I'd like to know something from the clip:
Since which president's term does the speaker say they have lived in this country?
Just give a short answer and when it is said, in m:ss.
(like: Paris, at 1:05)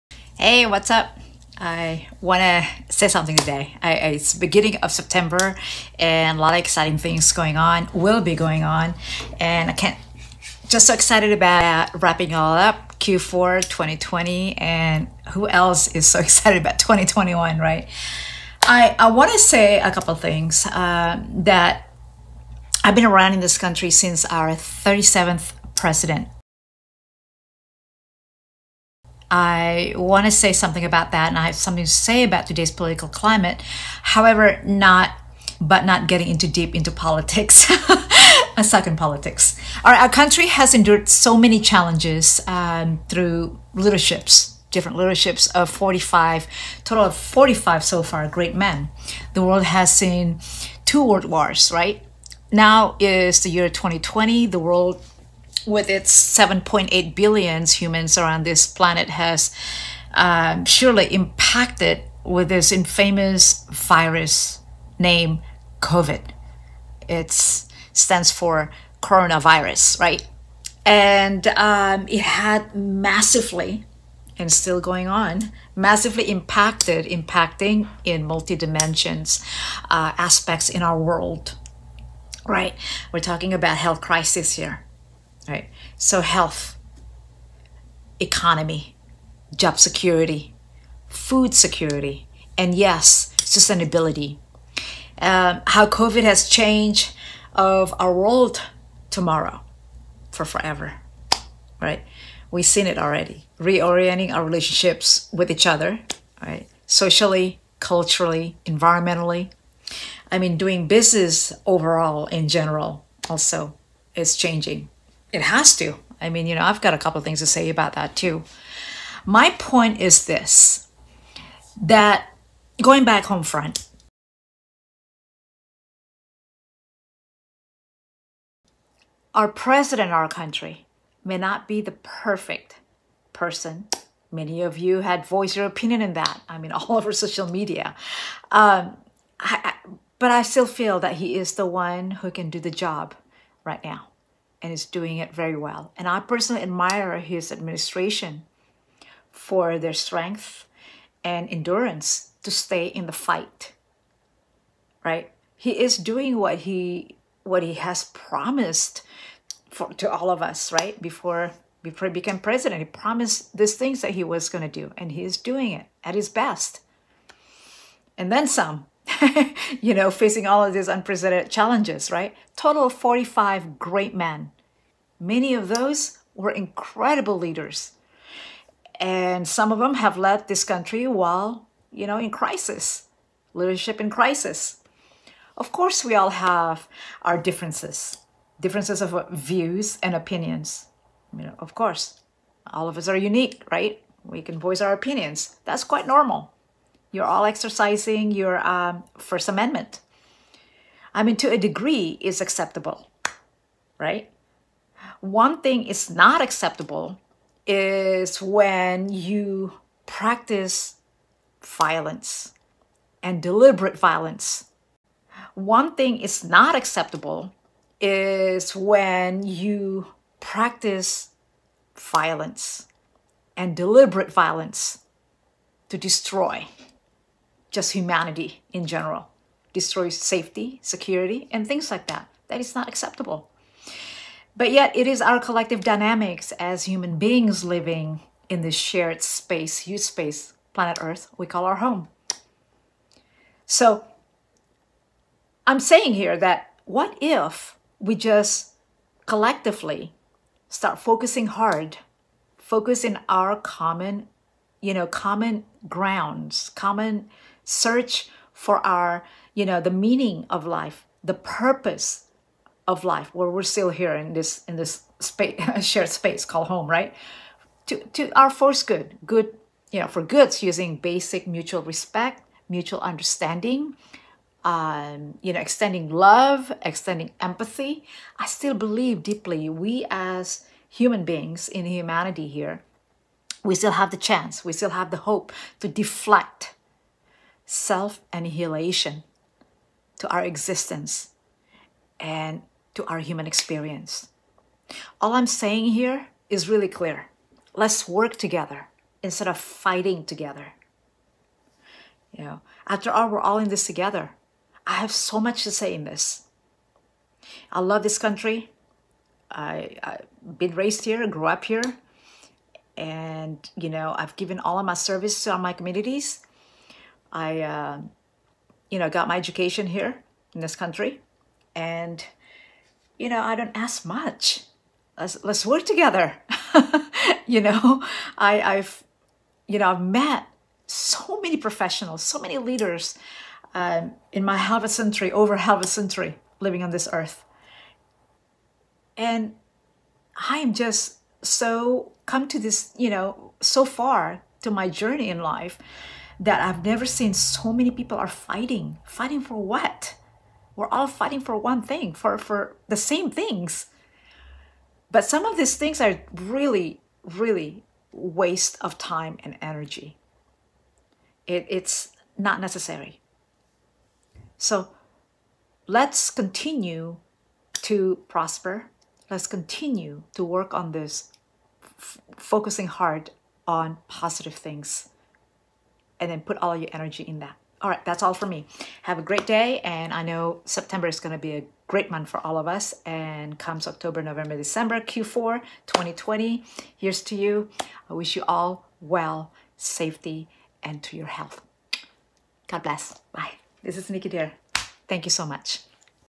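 37th, at 0:24.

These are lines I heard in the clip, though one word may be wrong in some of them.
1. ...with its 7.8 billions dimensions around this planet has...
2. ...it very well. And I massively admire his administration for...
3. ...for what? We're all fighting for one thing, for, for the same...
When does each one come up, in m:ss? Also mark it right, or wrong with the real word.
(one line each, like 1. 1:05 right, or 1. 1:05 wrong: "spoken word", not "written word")
1. 0:55 wrong: "humans", not "dimensions"
2. 2:25 wrong: "personally", not "massively"
3. 5:49 right.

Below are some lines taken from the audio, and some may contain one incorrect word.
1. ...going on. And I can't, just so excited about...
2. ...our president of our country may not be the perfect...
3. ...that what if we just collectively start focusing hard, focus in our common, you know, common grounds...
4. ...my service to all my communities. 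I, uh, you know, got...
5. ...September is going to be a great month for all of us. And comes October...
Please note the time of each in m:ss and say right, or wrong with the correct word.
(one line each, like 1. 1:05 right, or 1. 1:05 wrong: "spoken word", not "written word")
1. 0:08 right
2. 2:09 right
3. 4:06 right
4. 5:14 right
5. 6:20 right.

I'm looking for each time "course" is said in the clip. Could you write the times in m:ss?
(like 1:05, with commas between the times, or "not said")
3:05, 3:11.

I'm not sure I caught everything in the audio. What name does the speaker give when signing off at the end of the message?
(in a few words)
Nicky Dare.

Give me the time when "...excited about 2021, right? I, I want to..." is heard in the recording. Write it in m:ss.
0:16.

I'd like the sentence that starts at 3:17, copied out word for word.
You're all exercising your um, First Amendment.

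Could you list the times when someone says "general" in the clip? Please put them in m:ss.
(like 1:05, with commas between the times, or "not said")
1:52, 3:48.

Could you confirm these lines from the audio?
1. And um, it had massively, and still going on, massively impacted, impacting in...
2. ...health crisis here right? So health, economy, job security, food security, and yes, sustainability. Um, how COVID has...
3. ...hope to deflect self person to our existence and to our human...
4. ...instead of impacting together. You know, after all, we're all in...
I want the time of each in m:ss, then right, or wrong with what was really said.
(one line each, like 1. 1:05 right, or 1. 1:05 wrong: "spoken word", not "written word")
1. 1:10 right
2. 1:23 right
3. 4:45 wrong: "annihilation", not "person"
4. 4:59 wrong: "fighting", not "impacting".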